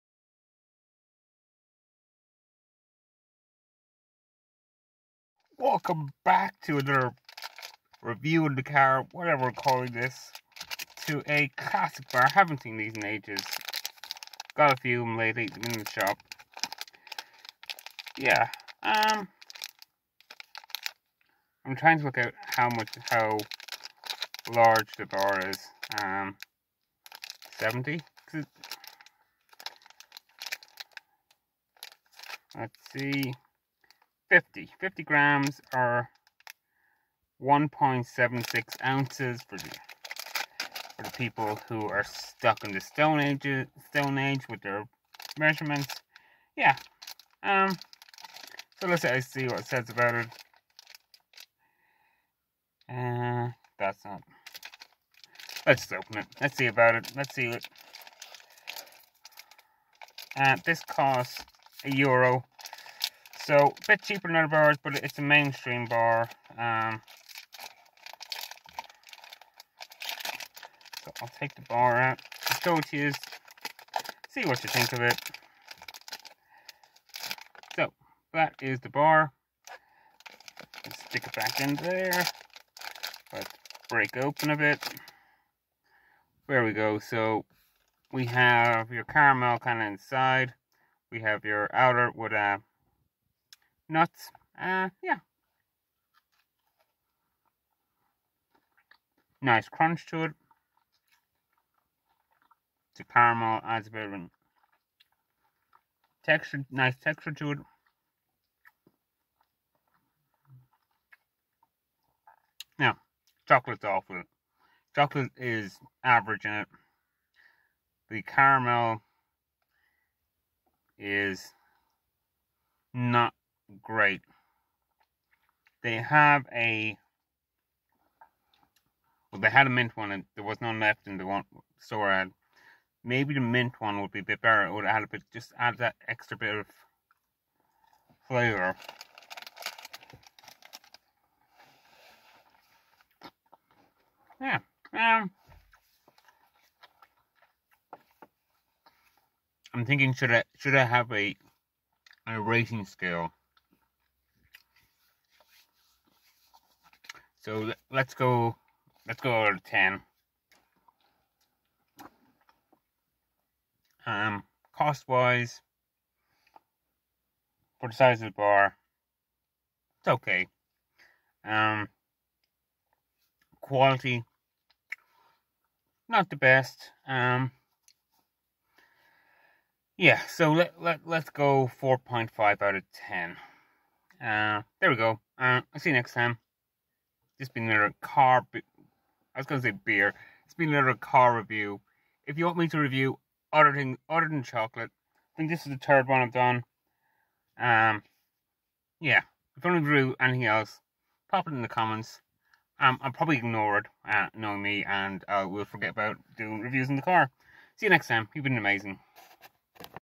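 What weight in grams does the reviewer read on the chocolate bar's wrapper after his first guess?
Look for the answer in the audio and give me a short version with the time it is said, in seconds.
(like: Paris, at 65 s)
50 grams, at 34 s.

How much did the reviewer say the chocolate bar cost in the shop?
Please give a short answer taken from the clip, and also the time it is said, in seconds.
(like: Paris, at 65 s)
a euro, at 61 s.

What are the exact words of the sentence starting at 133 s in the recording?
Maybe the mint one would be a bit better.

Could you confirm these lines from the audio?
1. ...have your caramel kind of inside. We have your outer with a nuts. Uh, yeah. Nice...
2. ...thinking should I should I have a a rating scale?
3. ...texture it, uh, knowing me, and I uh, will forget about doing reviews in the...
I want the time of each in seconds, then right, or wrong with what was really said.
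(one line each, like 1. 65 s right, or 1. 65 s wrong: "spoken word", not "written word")
1. 88 s right
2. 149 s right
3. 203 s wrong: "ignore", not "texture".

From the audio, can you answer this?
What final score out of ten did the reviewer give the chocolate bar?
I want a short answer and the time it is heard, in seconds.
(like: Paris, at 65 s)
4.5, at 181 s.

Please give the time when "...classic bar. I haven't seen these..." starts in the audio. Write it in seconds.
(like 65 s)
11 s.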